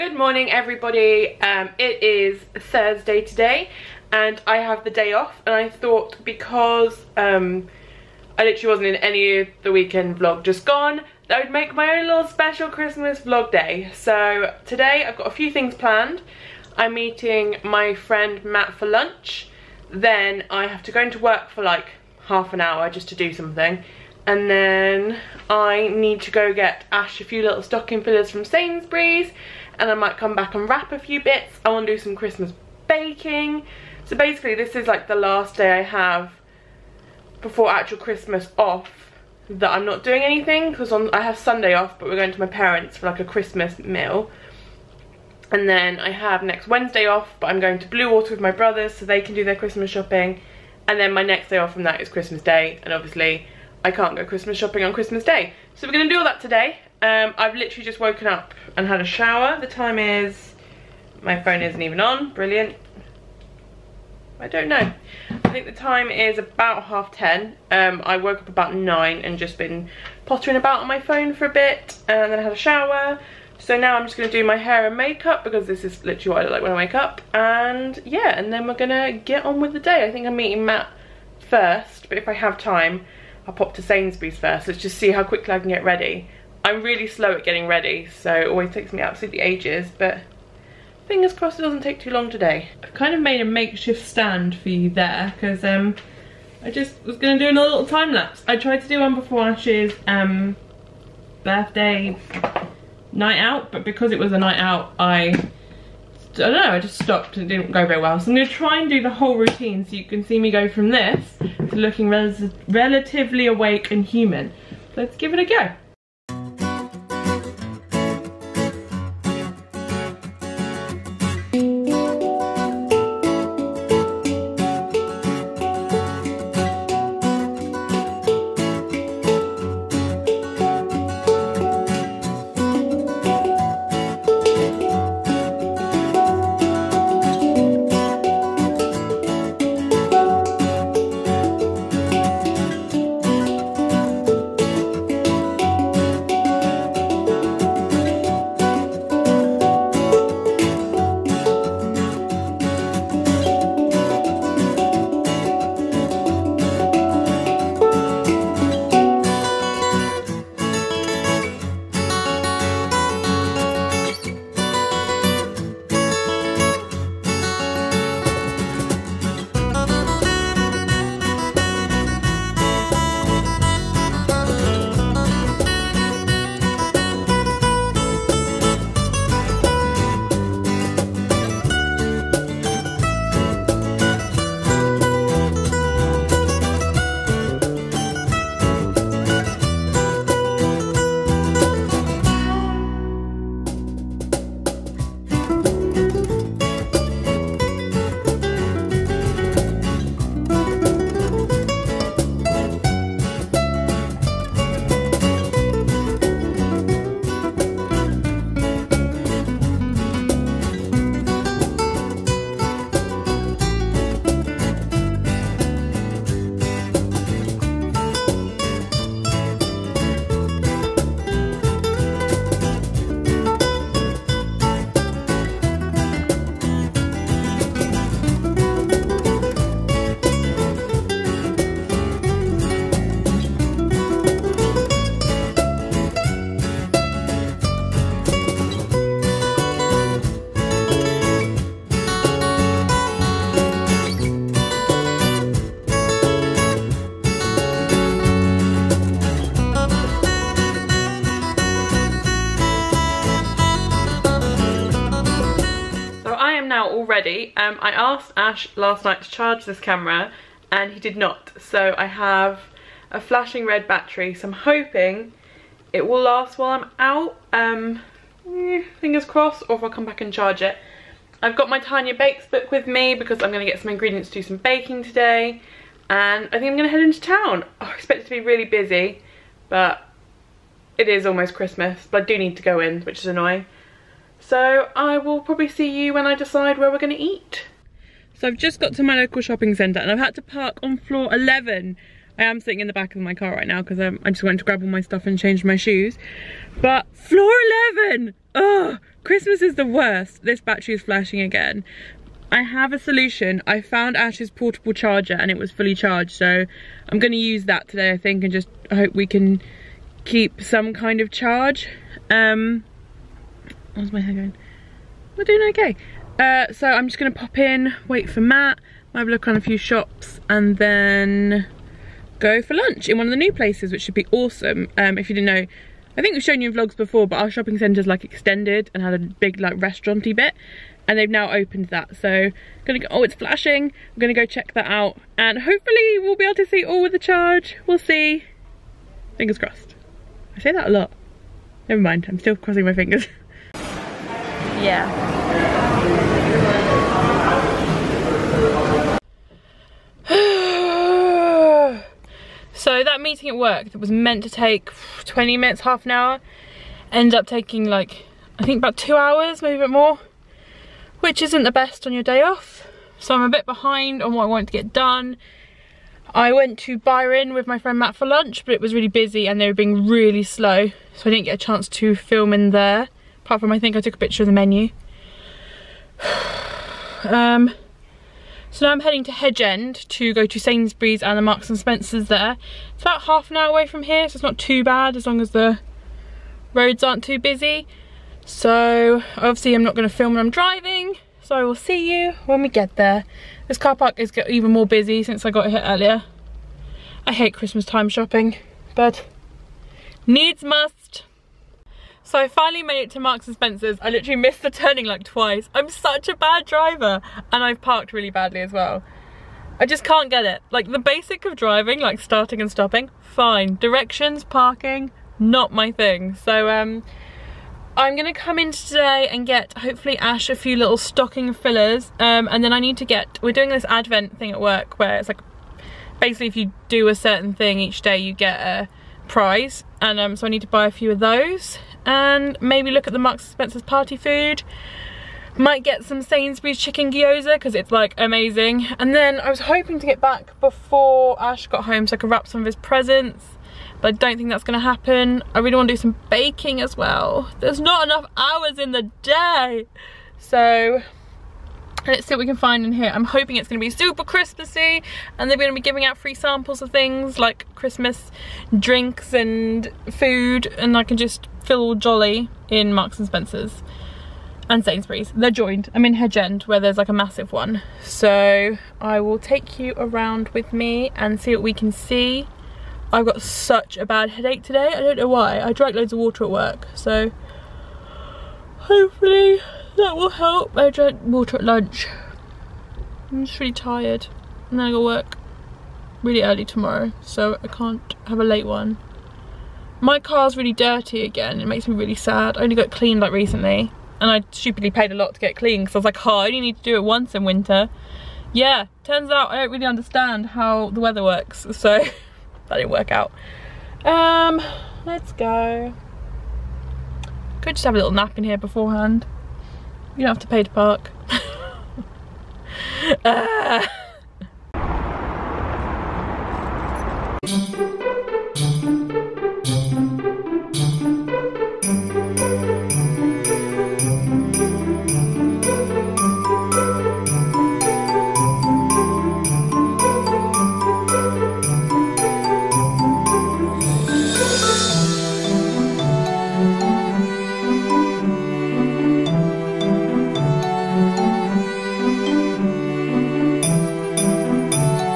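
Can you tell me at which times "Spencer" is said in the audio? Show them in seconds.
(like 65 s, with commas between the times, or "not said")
381 s, 403 s, 433 s, 463 s.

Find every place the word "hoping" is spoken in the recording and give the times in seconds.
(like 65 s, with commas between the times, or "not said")
264 s, 439 s, 453 s.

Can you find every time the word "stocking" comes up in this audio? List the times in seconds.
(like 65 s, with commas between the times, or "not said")
27 s, 420 s.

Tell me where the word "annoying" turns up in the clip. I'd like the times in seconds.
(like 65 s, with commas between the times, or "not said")
283 s.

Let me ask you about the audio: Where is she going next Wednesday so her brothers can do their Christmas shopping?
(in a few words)
Bluewater.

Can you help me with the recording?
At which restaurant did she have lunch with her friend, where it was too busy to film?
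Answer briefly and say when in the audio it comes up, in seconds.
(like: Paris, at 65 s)
Byron, at 366 s.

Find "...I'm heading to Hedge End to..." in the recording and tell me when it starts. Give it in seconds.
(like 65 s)
378 s.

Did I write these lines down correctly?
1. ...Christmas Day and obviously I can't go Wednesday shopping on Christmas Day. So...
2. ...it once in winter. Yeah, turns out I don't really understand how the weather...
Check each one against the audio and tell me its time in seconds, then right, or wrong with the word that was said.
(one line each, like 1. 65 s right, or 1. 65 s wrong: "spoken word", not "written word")
1. 52 s wrong: "Christmas", not "Wednesday"
2. 496 s right.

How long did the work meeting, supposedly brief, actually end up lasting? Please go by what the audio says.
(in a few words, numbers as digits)
About 2 hours.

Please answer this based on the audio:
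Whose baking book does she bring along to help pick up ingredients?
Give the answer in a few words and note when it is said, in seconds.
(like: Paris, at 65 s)
Tanya Bakes, at 271 s.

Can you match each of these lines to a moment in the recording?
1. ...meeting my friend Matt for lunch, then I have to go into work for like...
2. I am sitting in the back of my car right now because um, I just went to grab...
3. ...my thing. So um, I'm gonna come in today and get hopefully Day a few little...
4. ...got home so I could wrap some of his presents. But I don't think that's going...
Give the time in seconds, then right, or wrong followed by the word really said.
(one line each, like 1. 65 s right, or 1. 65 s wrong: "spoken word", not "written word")
1. 16 s right
2. 292 s right
3. 415 s wrong: "Ash", not "Day"
4. 441 s right.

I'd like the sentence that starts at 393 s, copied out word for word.
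This car park is even more busy since I got here earlier.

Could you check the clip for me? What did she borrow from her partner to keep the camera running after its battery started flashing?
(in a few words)
Portable charger.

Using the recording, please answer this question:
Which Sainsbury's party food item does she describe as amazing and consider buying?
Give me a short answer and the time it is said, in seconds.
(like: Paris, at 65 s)
Chicken gyoza, at 436 s.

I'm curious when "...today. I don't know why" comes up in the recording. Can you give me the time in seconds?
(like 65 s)
474 s.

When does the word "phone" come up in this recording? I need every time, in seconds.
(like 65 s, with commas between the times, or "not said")
61 s, 70 s.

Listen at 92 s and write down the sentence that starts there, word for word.
I've kind of made a makeshift stand for you there, because um, I just was going to do another little time lapse.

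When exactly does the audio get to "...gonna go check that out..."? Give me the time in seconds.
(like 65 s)
334 s.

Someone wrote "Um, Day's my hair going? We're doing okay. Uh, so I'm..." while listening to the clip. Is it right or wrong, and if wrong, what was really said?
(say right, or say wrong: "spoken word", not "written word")
wrong: "How", not "Day".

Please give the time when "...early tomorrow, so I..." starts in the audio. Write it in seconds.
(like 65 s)
486 s.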